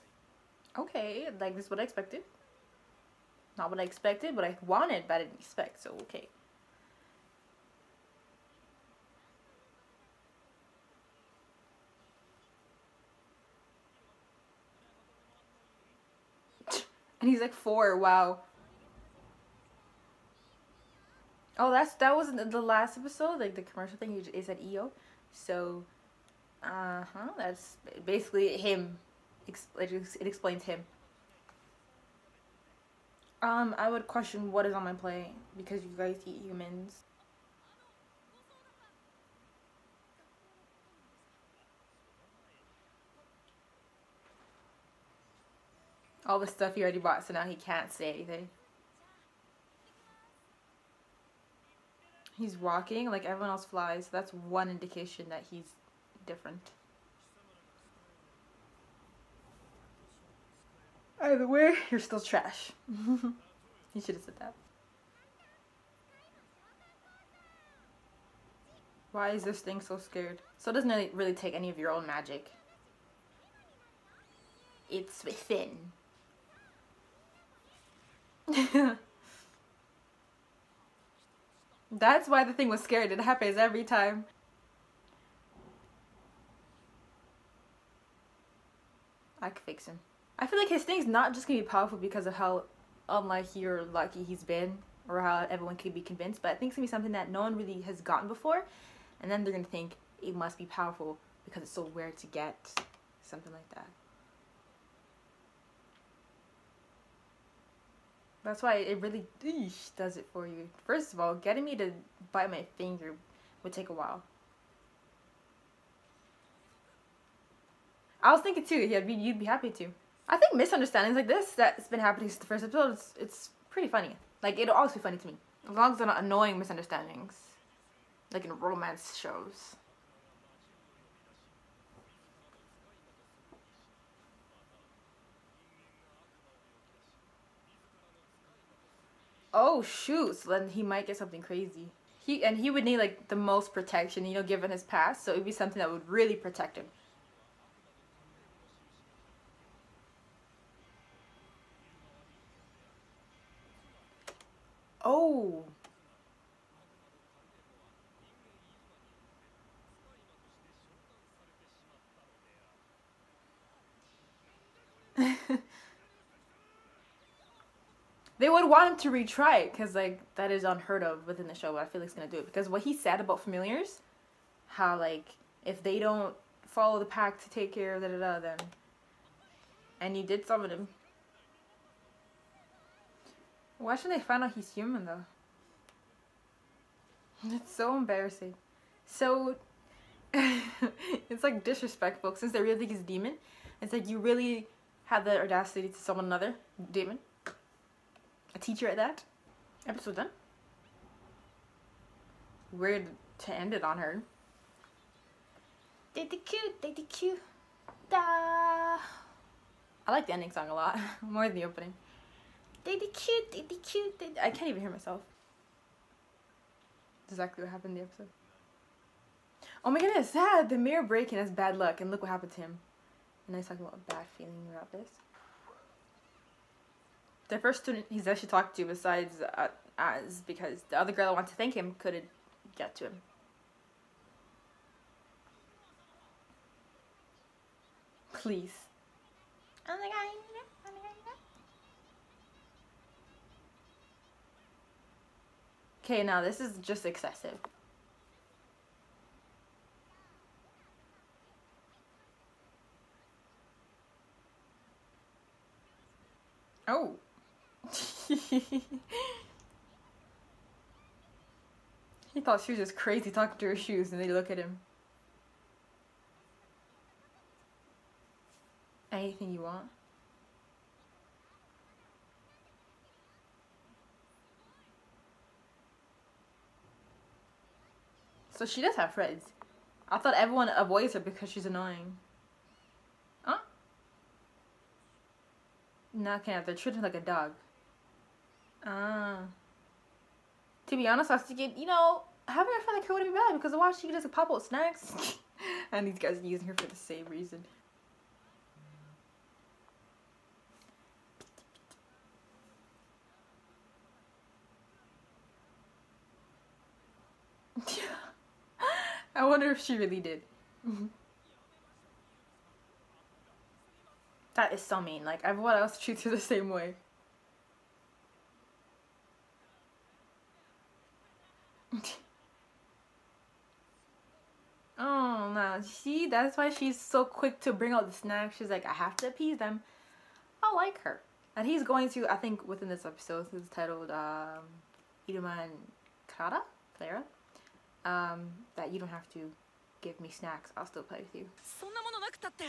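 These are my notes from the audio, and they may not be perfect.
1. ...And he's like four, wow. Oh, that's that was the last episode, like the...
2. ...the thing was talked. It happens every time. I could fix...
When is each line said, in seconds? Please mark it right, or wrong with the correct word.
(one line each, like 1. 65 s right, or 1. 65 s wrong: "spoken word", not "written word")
1. 17 s right
2. 82 s wrong: "scared", not "talked".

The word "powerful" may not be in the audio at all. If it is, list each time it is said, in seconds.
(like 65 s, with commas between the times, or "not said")
91 s, 100 s.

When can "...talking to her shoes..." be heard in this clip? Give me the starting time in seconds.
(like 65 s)
263 s.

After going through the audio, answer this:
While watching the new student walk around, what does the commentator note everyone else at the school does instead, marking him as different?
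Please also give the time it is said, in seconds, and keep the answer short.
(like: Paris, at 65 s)
Flies, at 53 s.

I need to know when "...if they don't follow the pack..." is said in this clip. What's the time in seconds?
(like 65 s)
175 s.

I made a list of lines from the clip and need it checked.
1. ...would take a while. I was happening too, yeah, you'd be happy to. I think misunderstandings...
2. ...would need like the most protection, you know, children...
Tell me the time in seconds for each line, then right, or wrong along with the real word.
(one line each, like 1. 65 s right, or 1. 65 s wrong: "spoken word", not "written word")
1. 113 s wrong: "thinking", not "happening"
2. 142 s wrong: "given", not "children".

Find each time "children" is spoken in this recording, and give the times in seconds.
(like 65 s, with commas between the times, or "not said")
286 s.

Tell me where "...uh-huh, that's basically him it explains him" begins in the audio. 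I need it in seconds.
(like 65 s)
26 s.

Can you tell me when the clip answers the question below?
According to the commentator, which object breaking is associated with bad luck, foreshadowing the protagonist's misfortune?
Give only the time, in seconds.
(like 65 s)
220 s.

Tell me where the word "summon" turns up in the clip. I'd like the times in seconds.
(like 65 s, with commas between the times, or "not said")
180 s, 195 s.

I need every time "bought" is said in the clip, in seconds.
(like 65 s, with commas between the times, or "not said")
46 s.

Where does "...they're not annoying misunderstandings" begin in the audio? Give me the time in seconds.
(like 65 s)
125 s.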